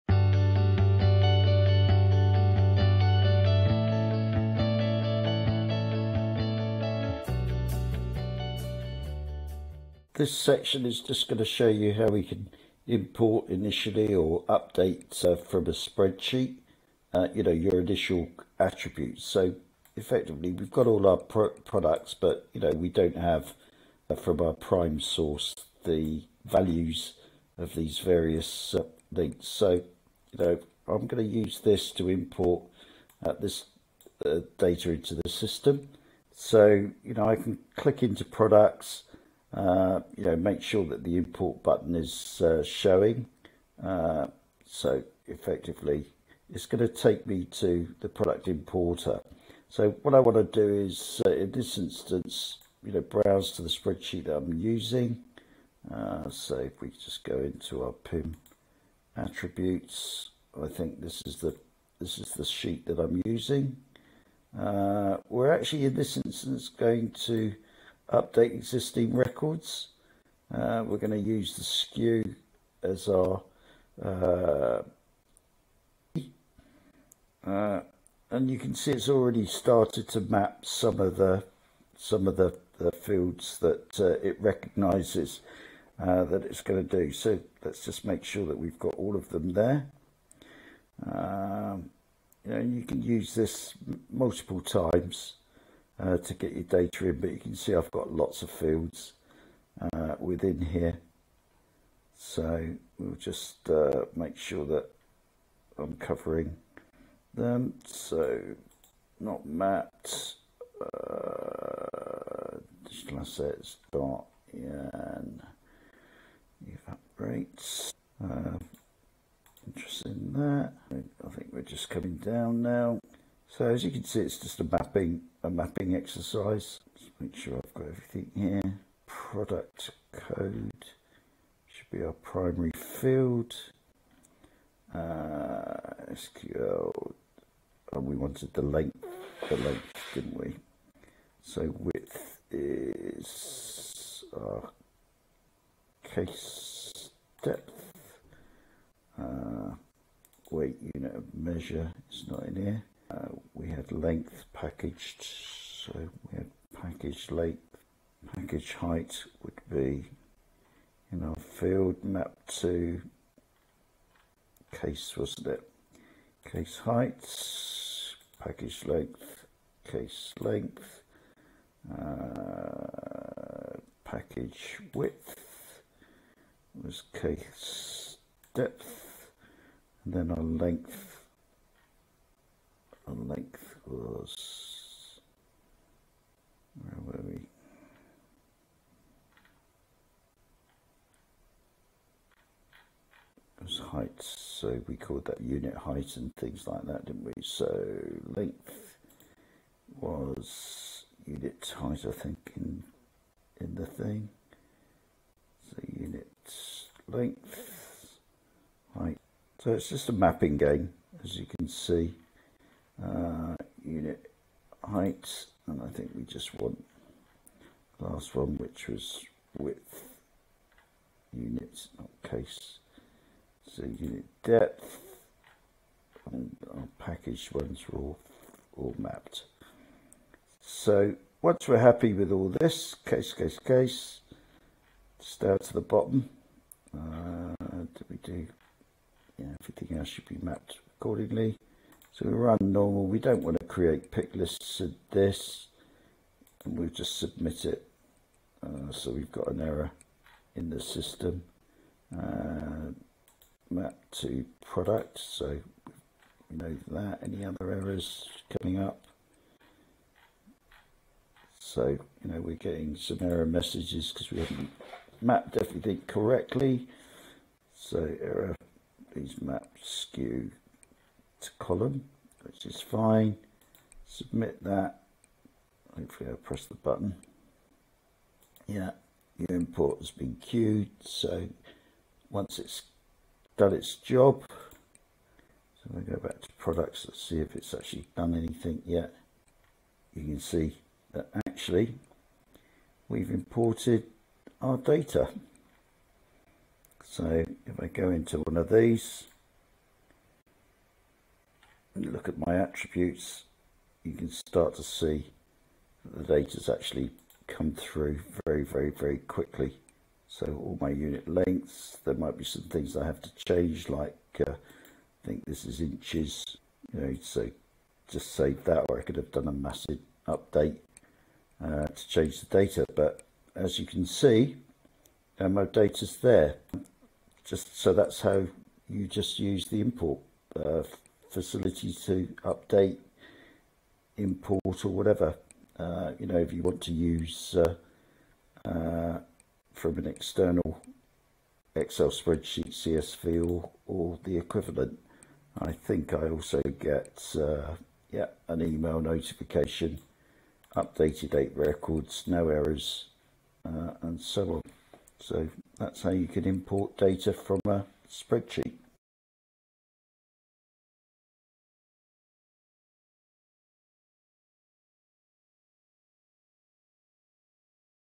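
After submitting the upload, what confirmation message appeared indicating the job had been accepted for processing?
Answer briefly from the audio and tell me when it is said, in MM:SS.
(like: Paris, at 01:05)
Your import has been queued, at 04:39.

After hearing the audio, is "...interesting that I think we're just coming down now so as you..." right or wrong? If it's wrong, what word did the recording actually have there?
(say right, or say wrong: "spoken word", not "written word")
right.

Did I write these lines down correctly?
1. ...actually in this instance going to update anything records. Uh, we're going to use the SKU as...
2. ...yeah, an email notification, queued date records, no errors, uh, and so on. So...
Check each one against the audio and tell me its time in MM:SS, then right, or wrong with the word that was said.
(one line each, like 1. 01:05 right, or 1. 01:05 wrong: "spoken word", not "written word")
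1. 01:05 wrong: "existing", not "anything"
2. 05:48 wrong: "updated", not "queued".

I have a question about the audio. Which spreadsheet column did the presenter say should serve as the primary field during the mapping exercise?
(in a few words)
Product code.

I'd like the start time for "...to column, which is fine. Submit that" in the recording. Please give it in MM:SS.
04:31.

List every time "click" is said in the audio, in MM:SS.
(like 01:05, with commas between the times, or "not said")
00:37.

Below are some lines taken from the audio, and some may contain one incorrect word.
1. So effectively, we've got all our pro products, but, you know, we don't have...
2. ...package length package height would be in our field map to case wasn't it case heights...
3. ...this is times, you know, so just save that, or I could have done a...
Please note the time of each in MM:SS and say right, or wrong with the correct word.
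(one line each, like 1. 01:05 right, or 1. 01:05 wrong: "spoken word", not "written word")
1. 00:19 right
2. 02:36 right
3. 05:15 wrong: "inches", not "times".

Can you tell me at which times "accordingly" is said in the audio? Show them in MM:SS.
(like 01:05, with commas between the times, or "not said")
04:00.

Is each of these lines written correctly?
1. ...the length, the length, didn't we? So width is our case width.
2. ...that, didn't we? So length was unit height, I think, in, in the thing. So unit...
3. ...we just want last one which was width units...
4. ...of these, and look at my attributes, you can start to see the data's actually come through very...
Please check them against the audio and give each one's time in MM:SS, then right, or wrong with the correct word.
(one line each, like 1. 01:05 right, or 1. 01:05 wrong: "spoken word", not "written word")
1. 02:18 wrong: "depth", not "width"
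2. 03:16 right
3. 03:36 right
4. 04:58 right.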